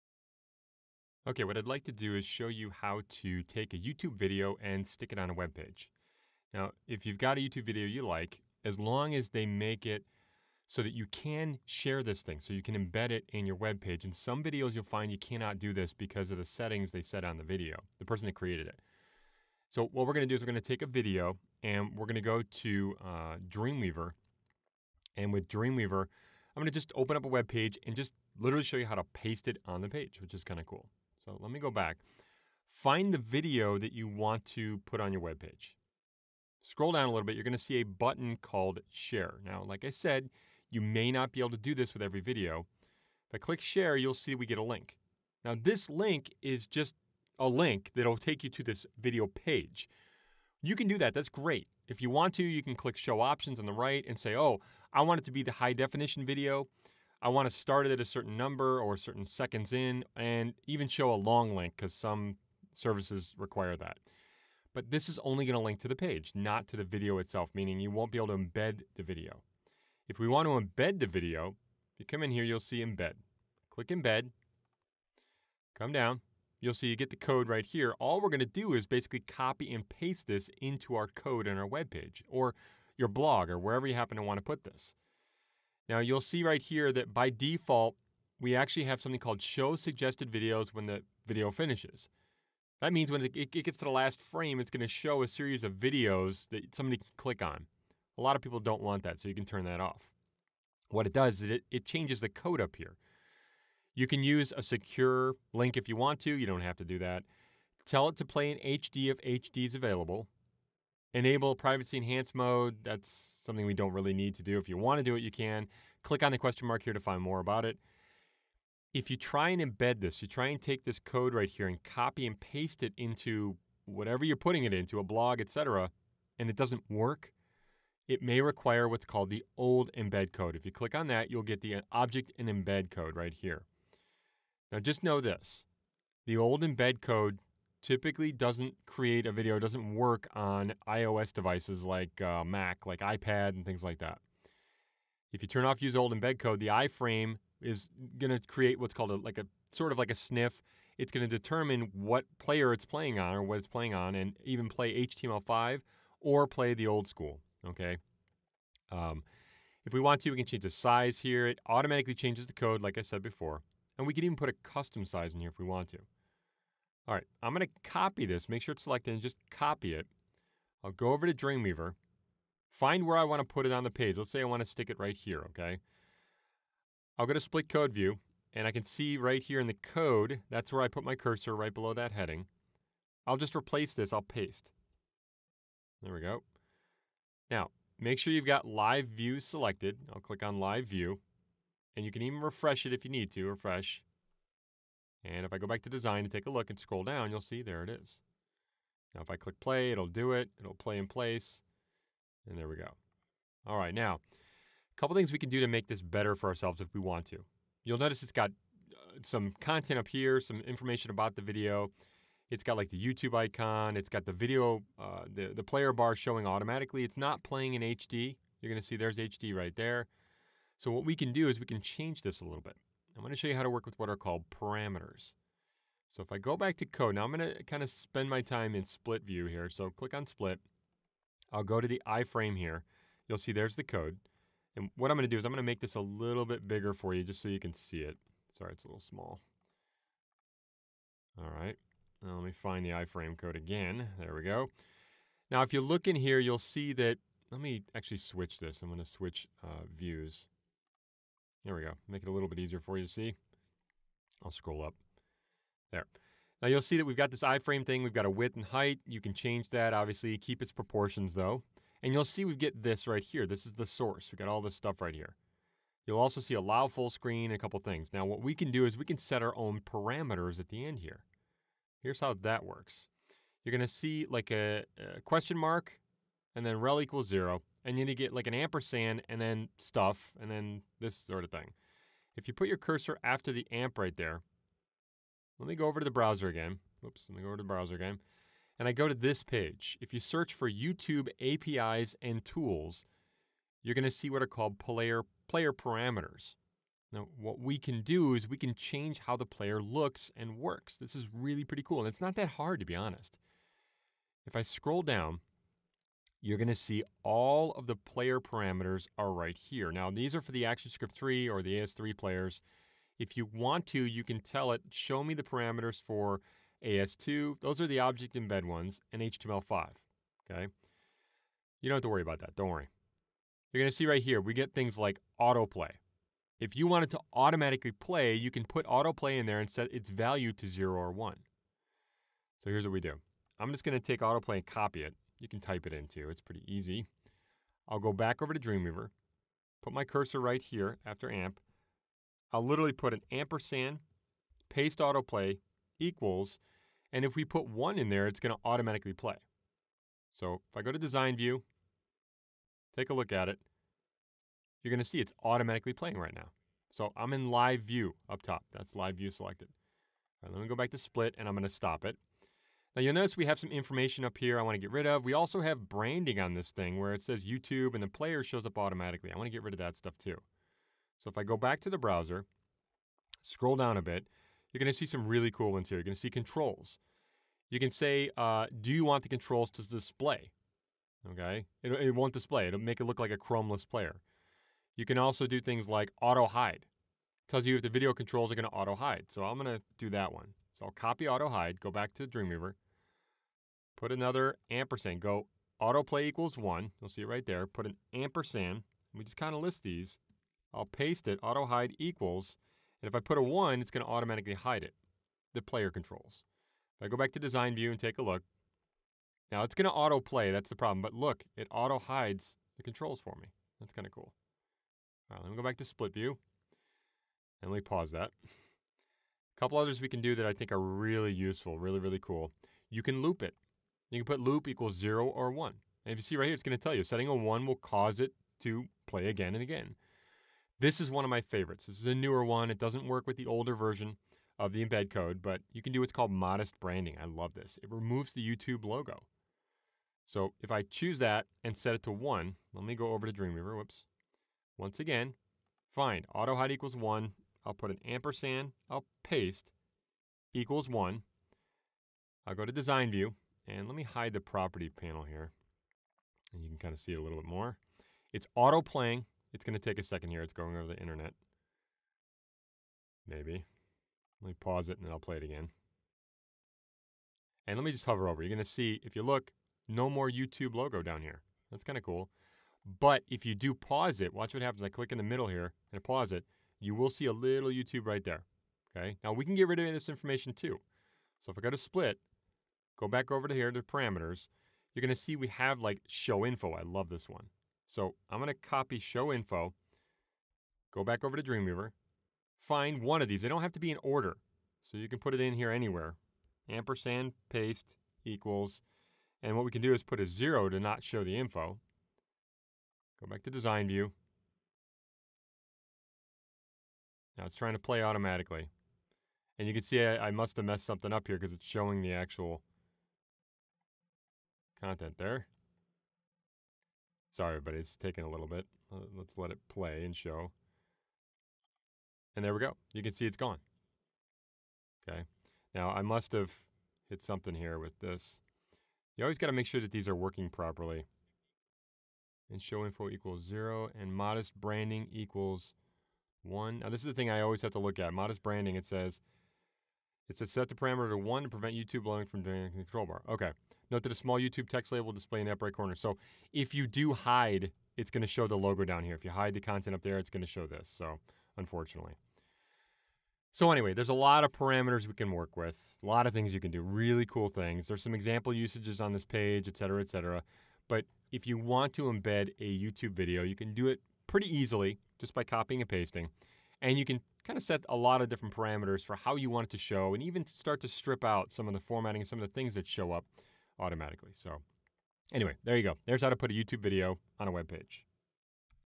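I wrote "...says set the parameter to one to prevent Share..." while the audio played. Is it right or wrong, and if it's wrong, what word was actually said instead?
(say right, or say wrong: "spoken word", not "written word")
wrong: "YouTube", not "Share".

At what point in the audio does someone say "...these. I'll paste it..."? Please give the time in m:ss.
6:39.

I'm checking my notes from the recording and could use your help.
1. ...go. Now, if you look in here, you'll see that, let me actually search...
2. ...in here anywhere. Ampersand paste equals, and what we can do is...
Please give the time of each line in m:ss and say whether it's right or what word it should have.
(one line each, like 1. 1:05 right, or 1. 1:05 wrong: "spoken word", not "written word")
1. 4:04 wrong: "switch", not "search"
2. 8:15 right.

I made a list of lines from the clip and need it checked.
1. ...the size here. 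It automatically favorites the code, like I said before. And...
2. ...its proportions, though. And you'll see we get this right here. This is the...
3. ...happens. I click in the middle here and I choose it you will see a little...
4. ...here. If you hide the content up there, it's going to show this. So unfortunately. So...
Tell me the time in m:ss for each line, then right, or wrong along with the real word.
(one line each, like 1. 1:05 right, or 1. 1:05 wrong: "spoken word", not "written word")
1. 2:40 wrong: "changes", not "favorites"
2. 4:20 right
3. 7:54 wrong: "pause", not "choose"
4. 9:09 right.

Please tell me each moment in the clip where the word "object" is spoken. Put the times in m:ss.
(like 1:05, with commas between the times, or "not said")
2:11, 5:17.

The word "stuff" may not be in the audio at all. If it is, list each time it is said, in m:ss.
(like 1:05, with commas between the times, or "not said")
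4:24, 4:39, 6:09.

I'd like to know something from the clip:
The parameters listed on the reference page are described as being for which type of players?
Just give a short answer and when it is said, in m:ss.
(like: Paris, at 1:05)
ActionScript 3, at 5:10.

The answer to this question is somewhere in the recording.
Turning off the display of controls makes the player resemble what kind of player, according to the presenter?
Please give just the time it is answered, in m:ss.
6:23.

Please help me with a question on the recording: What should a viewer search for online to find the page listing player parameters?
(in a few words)
YouTube APIs and tools.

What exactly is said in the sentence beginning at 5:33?
I'm just going to take autoplay and copy it you can type it into.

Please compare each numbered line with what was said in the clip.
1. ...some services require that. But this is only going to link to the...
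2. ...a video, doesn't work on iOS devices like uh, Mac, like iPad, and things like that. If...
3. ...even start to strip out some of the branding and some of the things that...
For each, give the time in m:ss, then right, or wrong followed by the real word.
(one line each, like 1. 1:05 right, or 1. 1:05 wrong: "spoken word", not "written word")
1. 1:01 right
2. 2:19 right
3. 9:30 wrong: "formatting", not "branding".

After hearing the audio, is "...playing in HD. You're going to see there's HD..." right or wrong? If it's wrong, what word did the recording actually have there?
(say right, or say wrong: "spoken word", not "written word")
right.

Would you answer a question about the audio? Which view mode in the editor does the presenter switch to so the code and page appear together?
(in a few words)
Split Code View.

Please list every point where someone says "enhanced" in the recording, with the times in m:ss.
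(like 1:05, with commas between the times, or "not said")
1:51.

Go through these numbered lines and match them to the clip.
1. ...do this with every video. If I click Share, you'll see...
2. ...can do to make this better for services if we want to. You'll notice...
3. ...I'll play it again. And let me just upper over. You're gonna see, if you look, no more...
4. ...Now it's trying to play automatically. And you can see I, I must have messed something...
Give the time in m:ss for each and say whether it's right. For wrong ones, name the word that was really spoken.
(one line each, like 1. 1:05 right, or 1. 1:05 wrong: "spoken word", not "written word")
1. 0:41 right
2. 3:25 wrong: "ourselves", not "services"
3. 7:45 wrong: "hover", not "upper"
4. 8:27 right.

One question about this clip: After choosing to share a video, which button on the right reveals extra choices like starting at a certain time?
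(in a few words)
Show Options.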